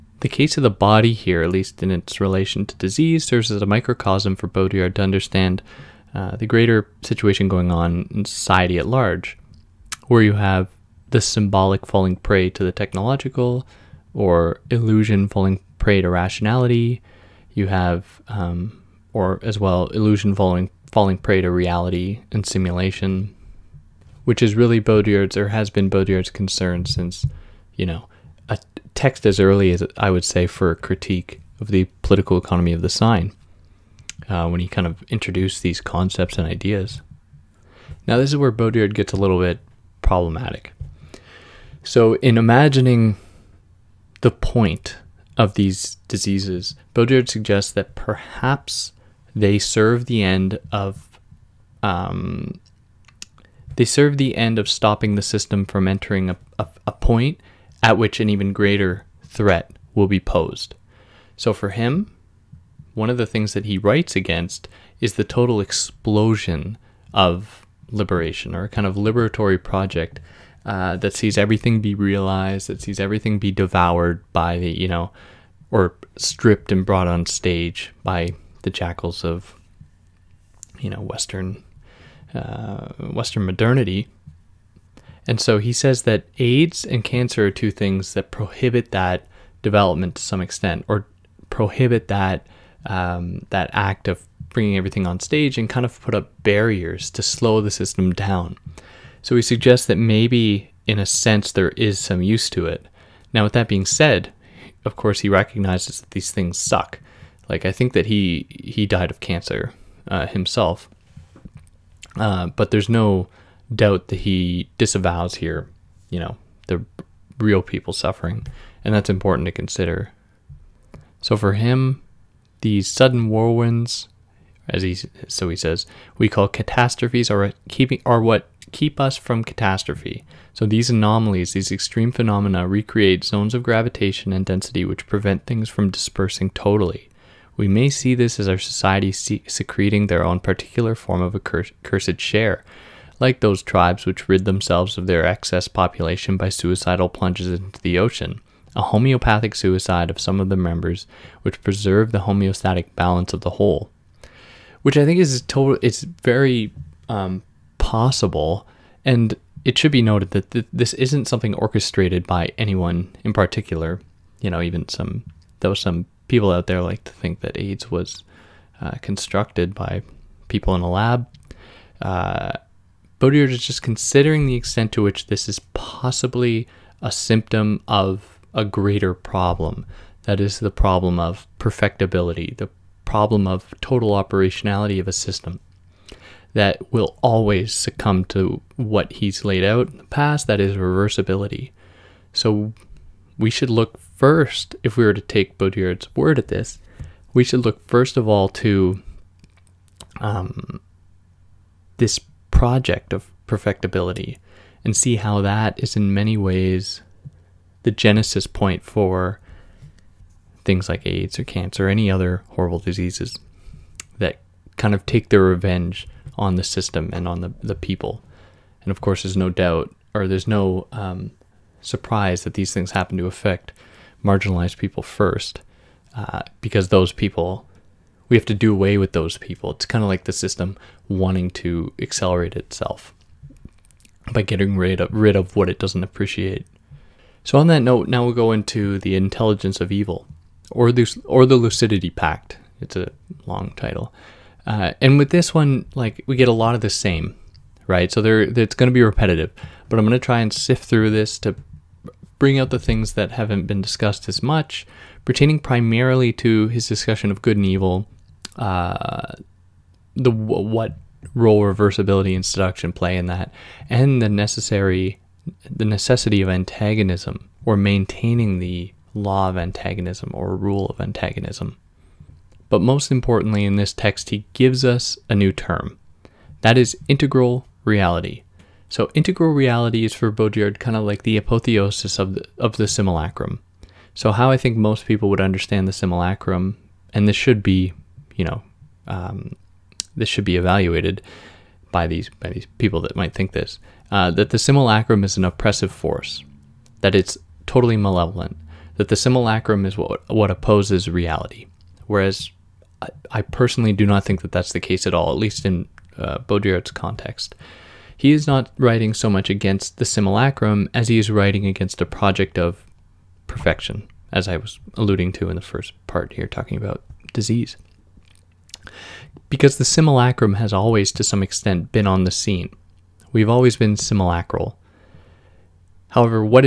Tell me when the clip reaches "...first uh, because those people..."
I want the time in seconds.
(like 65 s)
225 s.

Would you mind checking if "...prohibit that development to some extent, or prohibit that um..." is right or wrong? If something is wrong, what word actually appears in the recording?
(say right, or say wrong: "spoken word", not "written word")
right.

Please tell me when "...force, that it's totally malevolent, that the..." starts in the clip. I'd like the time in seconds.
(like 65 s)
295 s.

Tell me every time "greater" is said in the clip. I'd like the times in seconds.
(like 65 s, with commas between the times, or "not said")
6 s, 58 s, 178 s.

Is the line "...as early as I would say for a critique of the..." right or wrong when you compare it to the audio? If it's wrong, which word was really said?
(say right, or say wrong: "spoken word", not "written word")
right.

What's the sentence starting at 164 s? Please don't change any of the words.
You know, even some, though some people out there like to think that AIDS was uh, constructed by people in a lab.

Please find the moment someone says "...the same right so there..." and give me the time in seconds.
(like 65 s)
246 s.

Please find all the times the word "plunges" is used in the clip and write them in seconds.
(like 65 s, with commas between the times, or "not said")
147 s.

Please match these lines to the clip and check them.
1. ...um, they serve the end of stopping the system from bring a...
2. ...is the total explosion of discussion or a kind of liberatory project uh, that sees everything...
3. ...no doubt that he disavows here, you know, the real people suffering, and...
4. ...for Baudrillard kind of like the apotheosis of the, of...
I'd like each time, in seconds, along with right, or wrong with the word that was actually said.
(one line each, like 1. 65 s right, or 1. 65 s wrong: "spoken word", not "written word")
1. 51 s wrong: "entering", not "bring"
2. 65 s wrong: "liberation", not "discussion"
3. 112 s right
4. 280 s right.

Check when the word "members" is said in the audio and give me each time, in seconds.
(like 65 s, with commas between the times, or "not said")
150 s.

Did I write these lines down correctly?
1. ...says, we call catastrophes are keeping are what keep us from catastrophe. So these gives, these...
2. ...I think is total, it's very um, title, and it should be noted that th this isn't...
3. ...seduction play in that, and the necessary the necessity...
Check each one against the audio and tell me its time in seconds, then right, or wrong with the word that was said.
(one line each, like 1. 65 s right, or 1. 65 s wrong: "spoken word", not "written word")
1. 125 s wrong: "anomalies", not "gives"
2. 154 s wrong: "possible", not "title"
3. 262 s right.